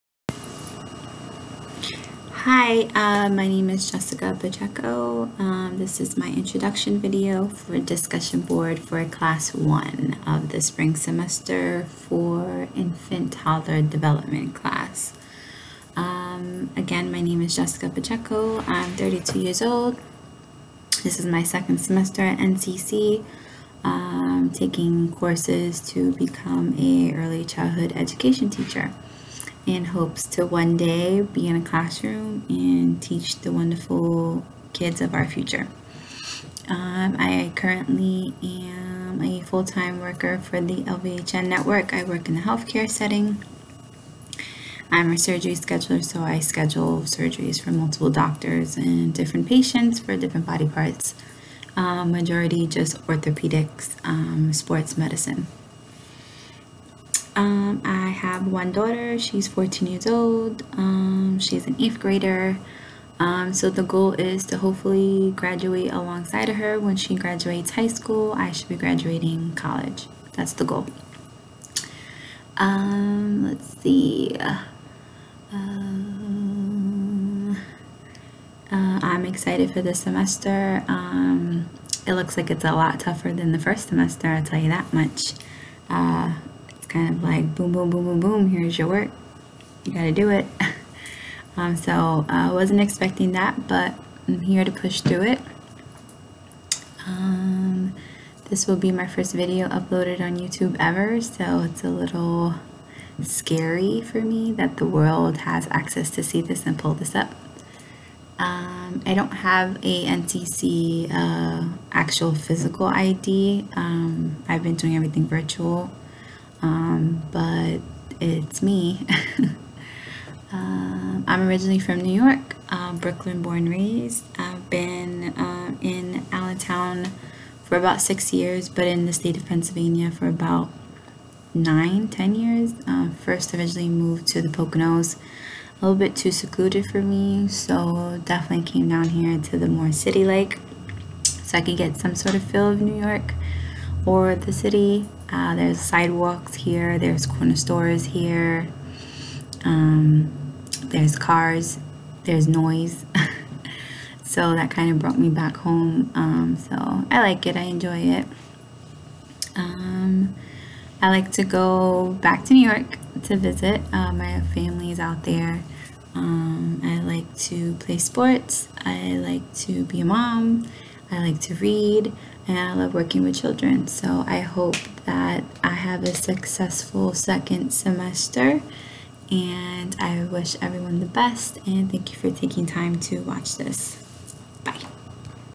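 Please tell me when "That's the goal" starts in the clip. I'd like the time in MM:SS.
01:10.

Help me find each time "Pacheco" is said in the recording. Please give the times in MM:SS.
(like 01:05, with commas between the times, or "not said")
00:04, 00:17.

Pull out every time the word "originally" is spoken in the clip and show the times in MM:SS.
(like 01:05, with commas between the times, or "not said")
02:01, 02:13.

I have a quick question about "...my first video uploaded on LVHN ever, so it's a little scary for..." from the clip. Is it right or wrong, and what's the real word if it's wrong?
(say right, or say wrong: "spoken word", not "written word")
wrong: "YouTube", not "LVHN".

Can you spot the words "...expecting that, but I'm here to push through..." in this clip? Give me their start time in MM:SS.
01:32.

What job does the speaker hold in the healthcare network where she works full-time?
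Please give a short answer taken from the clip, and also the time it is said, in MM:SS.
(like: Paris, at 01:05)
Surgery scheduler, at 00:45.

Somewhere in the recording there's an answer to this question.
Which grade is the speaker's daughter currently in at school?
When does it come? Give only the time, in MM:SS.
01:01.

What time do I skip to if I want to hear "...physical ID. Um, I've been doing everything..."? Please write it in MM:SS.
01:52.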